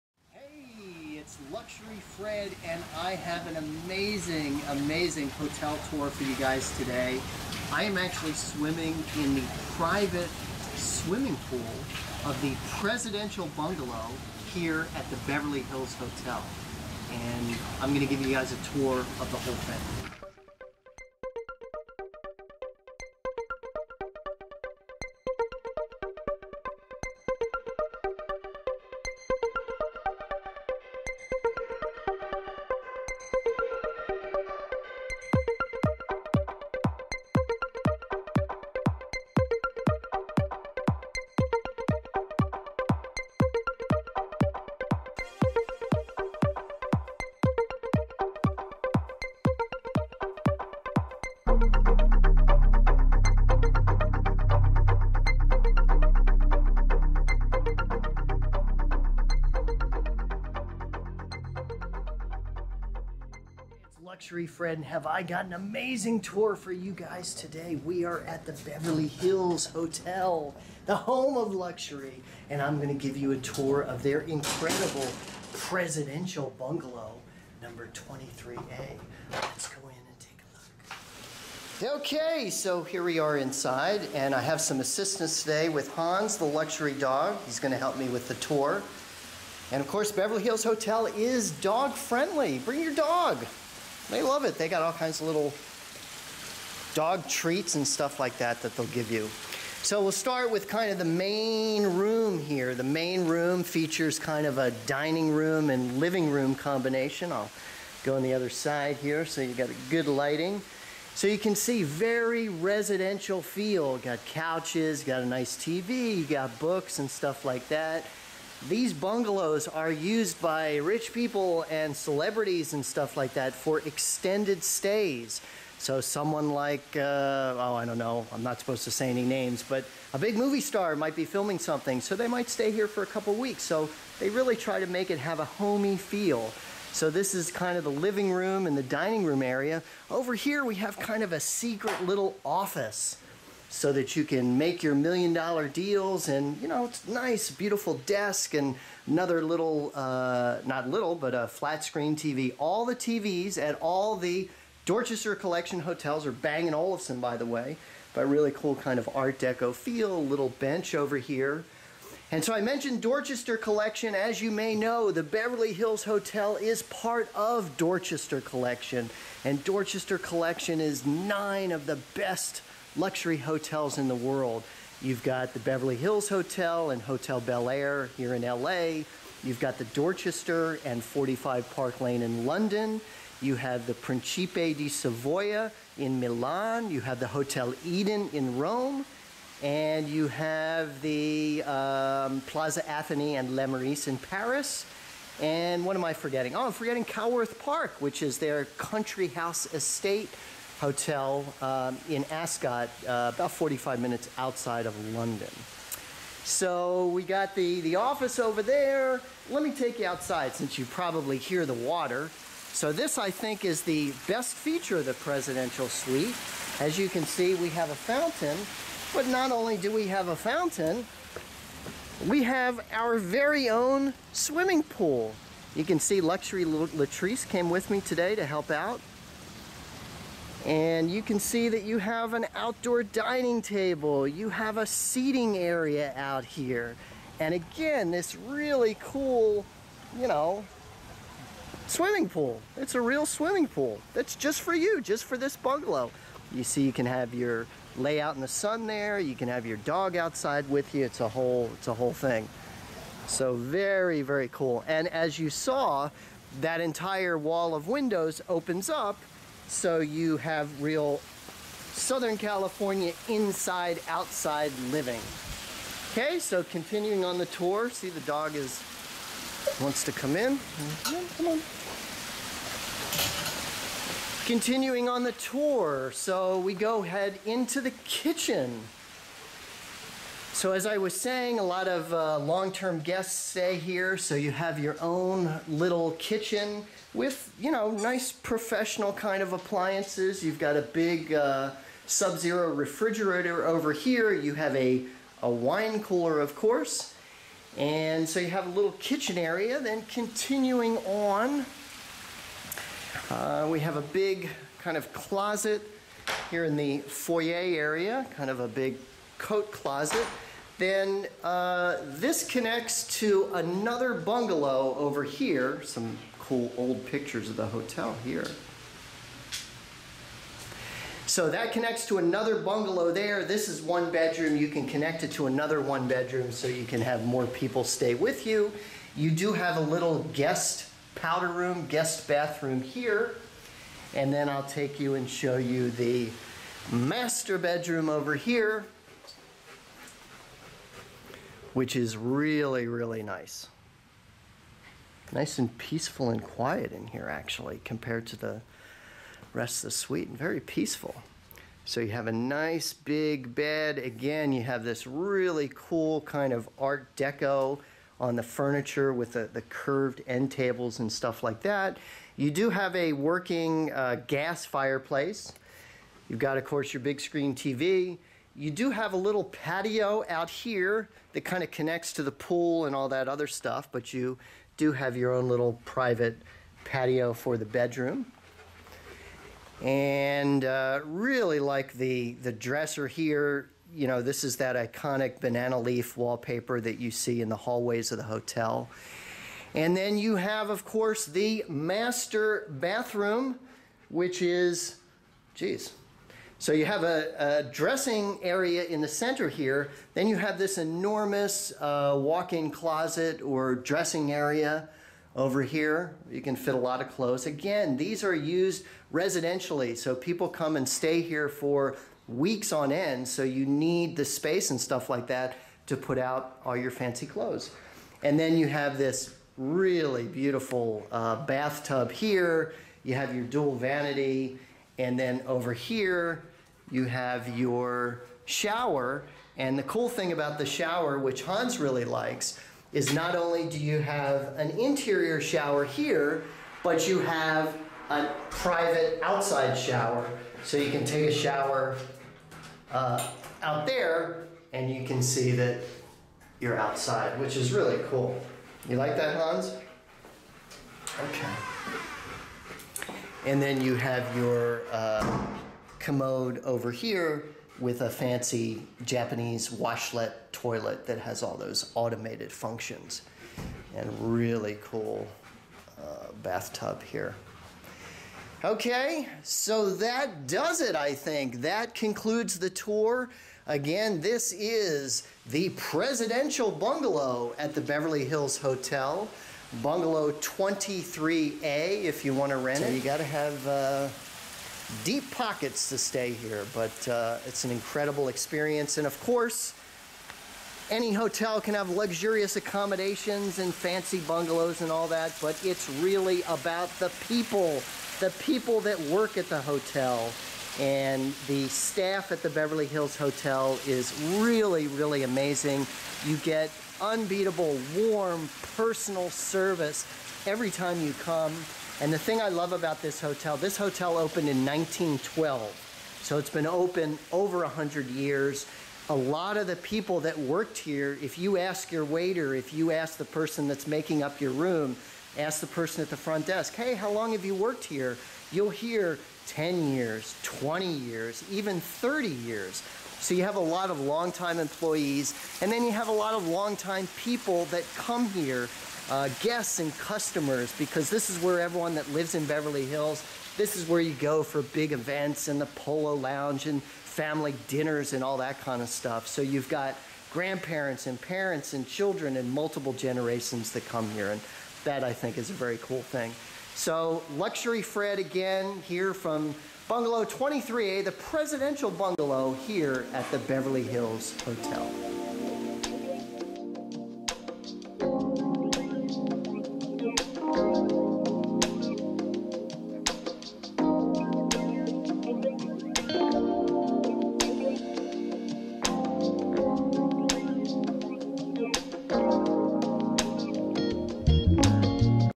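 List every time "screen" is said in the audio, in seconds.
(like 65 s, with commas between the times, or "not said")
151 s, 367 s.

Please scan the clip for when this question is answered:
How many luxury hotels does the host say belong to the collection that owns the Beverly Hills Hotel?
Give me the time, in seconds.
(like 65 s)
171 s.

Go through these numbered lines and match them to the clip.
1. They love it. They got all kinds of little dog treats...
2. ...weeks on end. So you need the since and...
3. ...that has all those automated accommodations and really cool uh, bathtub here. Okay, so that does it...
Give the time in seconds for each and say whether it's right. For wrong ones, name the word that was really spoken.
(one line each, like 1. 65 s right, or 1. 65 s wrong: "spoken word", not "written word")
1. 94 s right
2. 412 s wrong: "space", not "since"
3. 461 s wrong: "functions", not "accommodations".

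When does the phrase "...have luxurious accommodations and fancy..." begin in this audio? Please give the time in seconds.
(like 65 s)
491 s.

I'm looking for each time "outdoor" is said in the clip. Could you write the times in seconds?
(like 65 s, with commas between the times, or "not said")
232 s.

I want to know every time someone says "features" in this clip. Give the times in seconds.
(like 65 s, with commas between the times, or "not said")
103 s, 214 s.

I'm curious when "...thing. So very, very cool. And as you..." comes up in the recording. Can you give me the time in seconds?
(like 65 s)
252 s.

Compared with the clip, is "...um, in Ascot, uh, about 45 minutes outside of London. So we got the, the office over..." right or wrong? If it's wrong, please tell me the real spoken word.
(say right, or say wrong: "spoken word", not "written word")
right.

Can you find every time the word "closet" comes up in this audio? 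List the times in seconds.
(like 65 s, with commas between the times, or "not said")
305 s, 309 s, 402 s.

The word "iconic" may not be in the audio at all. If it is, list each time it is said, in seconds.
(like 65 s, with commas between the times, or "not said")
384 s.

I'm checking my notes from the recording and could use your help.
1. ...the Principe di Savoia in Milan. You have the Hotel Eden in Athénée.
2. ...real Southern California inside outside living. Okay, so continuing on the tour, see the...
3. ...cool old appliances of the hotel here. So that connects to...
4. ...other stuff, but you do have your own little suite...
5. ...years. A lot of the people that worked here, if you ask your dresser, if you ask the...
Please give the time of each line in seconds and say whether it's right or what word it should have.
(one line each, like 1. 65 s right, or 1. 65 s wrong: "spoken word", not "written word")
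1. 183 s wrong: "Rome", not "Athénée"
2. 260 s right
3. 316 s wrong: "pictures", not "appliances"
4. 373 s wrong: "private", not "suite"
5. 518 s wrong: "waiter", not "dresser".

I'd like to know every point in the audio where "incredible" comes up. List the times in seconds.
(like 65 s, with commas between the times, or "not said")
74 s, 487 s.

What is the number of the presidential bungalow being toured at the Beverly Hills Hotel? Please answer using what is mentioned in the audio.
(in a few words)
23A.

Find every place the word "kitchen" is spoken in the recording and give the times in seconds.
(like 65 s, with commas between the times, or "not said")
278 s, 286 s, 298 s.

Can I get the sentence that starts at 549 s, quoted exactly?
So you've got grandparents and parents and children and multiple generations that come here.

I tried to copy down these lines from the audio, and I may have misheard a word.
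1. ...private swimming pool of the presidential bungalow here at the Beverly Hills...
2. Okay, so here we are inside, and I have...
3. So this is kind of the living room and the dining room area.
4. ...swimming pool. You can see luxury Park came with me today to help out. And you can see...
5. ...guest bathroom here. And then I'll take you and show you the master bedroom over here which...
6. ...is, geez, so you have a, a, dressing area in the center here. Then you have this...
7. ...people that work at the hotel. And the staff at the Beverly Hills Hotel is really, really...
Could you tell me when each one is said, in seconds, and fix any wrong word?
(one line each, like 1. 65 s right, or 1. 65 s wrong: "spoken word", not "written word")
1. 9 s right
2. 82 s right
3. 136 s right
4. 224 s wrong: "Latrice", not "Park"
5. 331 s right
6. 394 s right
7. 498 s right.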